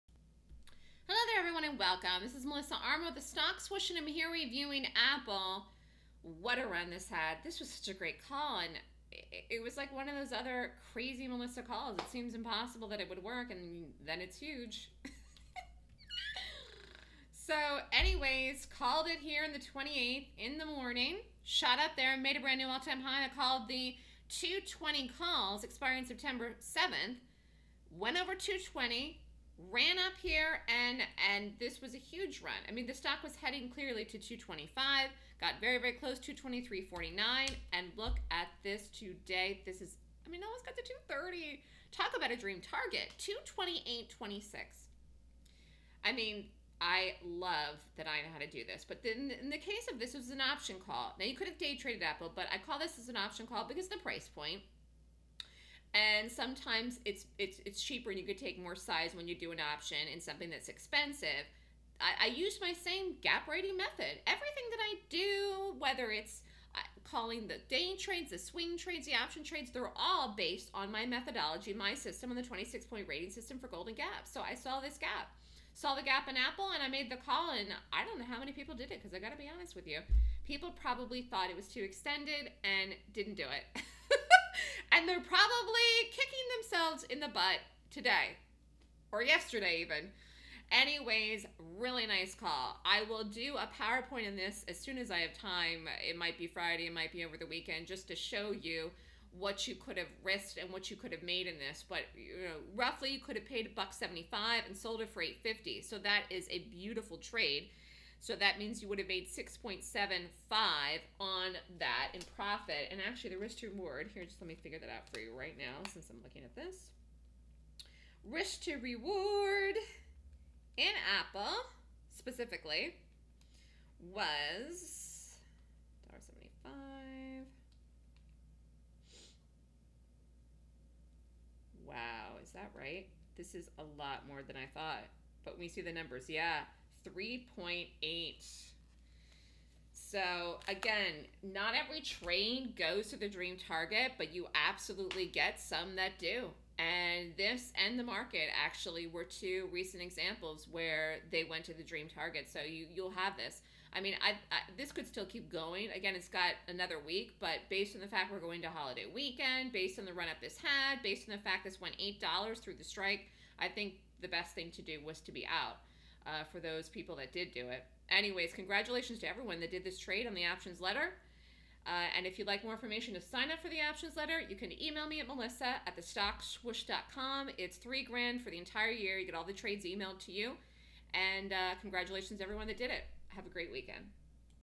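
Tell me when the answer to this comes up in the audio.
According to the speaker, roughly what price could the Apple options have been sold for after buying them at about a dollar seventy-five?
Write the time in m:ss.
1:45.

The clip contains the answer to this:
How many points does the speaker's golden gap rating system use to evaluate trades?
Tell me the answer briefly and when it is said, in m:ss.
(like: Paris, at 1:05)
26, at 1:12.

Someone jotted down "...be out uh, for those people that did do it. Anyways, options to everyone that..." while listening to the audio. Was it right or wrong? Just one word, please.
wrong.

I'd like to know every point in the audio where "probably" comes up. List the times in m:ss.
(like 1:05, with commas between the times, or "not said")
1:20, 1:25.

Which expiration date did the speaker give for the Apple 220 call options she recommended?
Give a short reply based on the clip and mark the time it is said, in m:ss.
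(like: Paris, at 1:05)
September 7th, at 0:26.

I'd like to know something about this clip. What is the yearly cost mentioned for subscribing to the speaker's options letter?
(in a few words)
$3,000.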